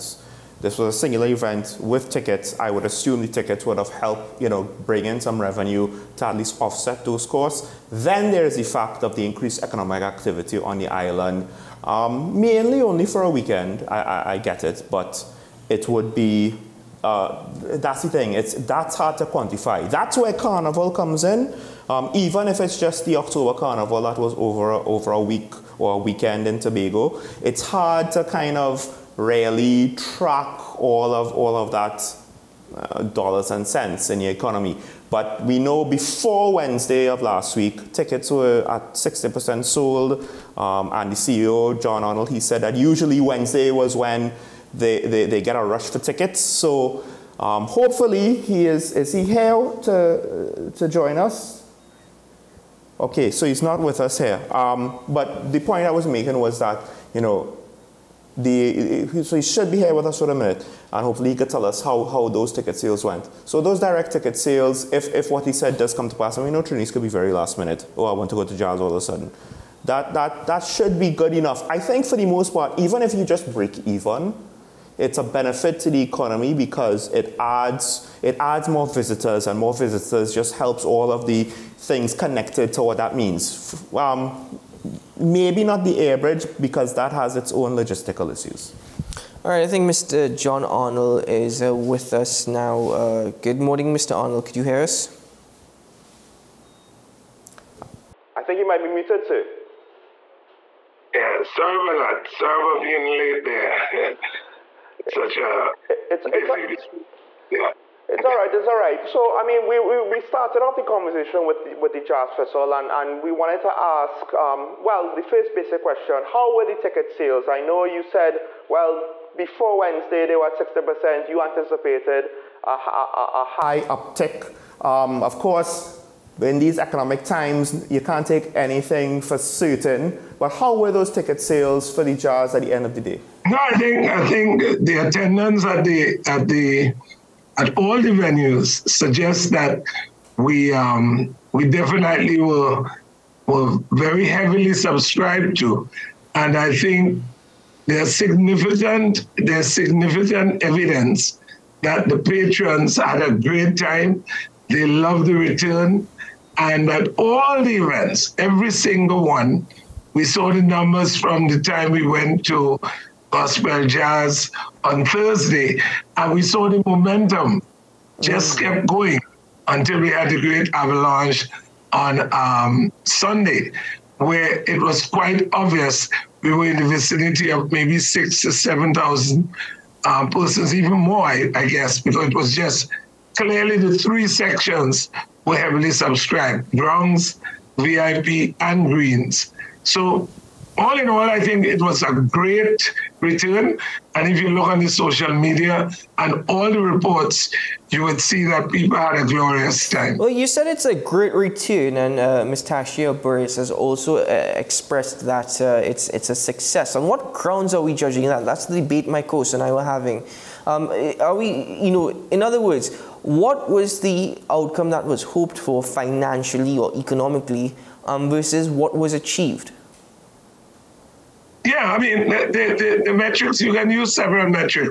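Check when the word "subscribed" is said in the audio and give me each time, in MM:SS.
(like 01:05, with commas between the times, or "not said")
02:24, 03:05.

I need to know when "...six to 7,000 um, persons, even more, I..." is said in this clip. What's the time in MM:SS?
02:57.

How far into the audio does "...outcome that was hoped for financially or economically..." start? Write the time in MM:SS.
03:34.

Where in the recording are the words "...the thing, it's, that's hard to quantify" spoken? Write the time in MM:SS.
00:18.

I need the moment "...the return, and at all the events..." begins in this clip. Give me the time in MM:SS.
02:35.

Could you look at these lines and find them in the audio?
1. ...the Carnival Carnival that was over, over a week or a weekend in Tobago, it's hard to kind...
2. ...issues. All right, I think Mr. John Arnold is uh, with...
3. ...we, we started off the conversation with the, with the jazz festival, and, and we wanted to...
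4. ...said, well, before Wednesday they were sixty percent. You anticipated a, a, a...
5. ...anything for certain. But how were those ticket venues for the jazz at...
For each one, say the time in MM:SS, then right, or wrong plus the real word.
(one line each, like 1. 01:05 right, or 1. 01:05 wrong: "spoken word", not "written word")
1. 00:23 wrong: "October", not "Carnival"
2. 01:28 right
3. 01:49 right
4. 01:58 right
5. 02:08 wrong: "sales", not "venues".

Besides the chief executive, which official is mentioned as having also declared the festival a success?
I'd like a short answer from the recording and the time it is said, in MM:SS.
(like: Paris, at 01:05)
Tashia Burris, at 03:22.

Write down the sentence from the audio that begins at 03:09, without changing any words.
So all in all, I think it was a great return.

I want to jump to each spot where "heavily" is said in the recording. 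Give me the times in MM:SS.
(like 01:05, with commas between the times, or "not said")
02:24, 03:05.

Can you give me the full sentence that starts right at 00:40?
Um, and the CEO, John Arnold, he said that usually Wednesday was when they, they, they get a rush for tickets.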